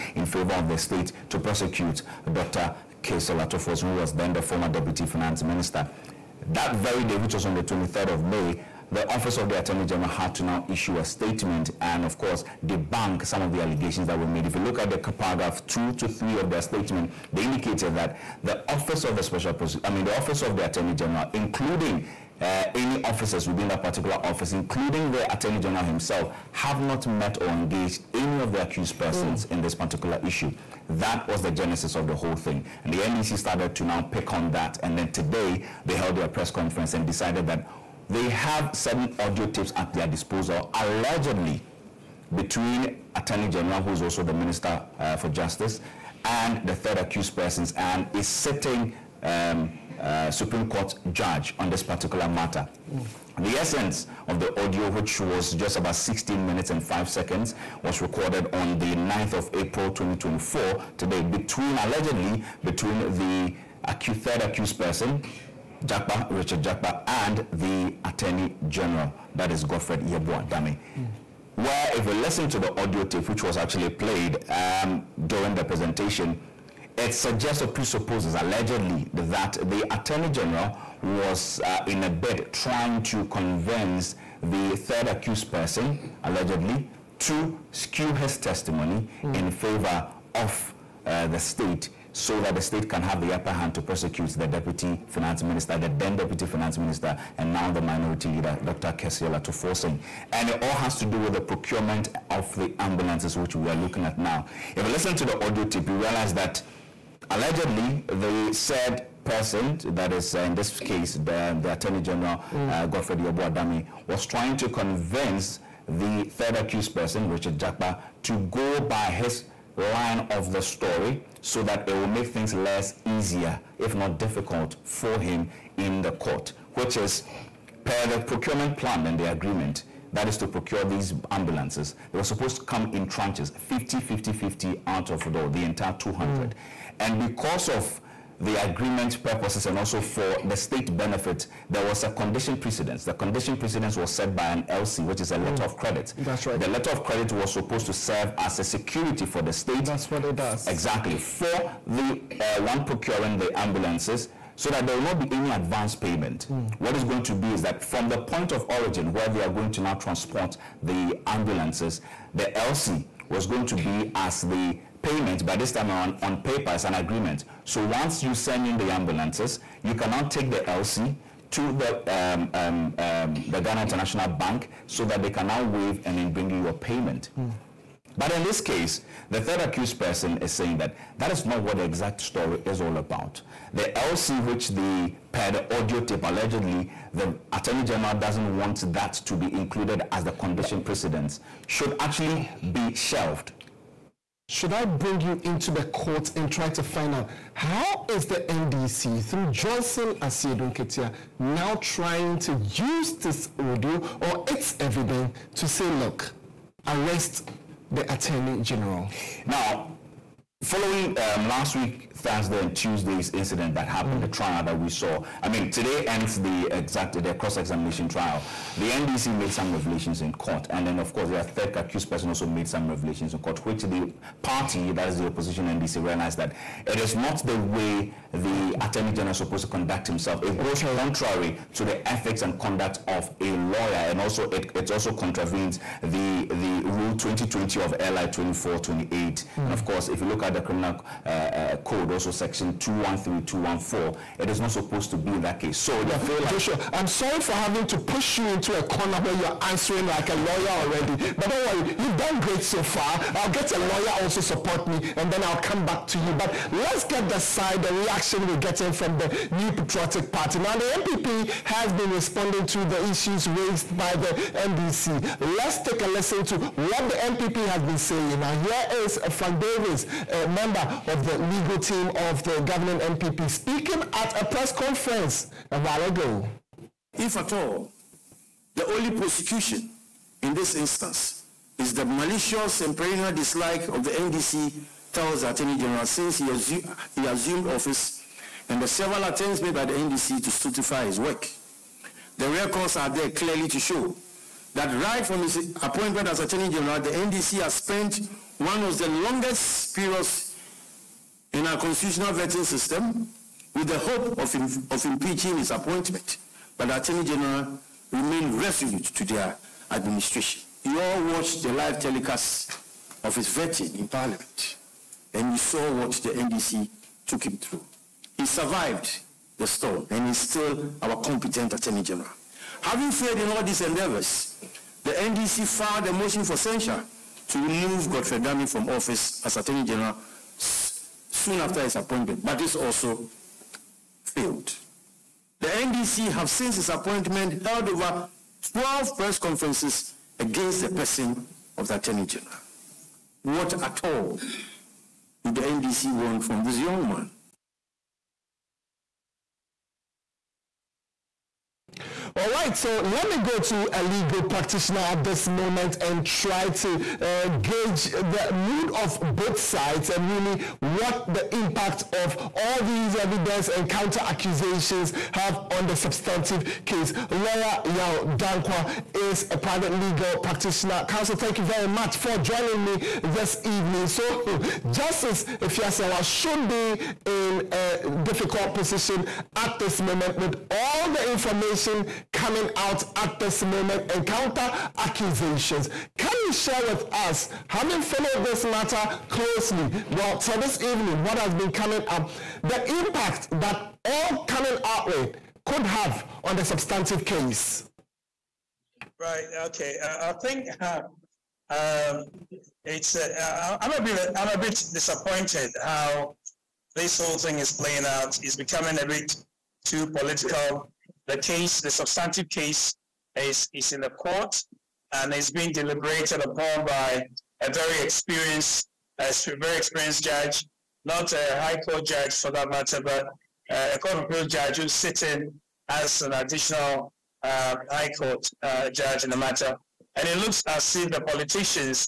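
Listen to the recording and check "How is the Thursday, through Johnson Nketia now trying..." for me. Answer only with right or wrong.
wrong.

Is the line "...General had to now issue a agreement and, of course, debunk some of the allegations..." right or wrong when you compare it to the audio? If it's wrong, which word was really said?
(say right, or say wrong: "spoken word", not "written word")
wrong: "statement", not "agreement".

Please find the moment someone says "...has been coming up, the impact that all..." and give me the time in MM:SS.
06:31.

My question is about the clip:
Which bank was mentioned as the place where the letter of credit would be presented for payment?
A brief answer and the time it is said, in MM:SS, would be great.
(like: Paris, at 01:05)
Ghana International Bank, at 02:53.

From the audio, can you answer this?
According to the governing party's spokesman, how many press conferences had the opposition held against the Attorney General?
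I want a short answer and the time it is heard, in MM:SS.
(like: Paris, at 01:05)
over 12, at 05:37.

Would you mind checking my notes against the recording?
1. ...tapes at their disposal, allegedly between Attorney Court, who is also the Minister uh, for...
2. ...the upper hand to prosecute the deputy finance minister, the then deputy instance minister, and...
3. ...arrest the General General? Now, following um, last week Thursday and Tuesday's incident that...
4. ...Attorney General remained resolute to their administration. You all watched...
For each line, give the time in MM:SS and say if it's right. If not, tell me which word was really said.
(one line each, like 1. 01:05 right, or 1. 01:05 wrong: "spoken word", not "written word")
1. 00:39 wrong: "General", not "Court"
2. 01:33 wrong: "finance", not "instance"
3. 03:26 wrong: "Attorney", not "General"
4. 05:06 right.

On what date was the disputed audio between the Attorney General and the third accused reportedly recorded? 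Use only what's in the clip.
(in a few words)
9th of April 2024.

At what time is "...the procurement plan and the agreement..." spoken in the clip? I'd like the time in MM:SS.
02:08.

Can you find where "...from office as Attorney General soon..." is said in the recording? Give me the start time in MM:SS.
05:28.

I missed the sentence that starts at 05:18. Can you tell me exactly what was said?
He survived the storm and is still our competent Attorney General.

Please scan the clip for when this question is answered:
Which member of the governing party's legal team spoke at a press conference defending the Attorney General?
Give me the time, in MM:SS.
04:29.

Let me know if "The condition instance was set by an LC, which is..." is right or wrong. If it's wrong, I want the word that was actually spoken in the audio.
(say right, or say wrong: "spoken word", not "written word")
wrong: "precedence", not "instance".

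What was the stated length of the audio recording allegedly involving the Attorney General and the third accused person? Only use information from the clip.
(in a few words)
16 minutes and 5 seconds.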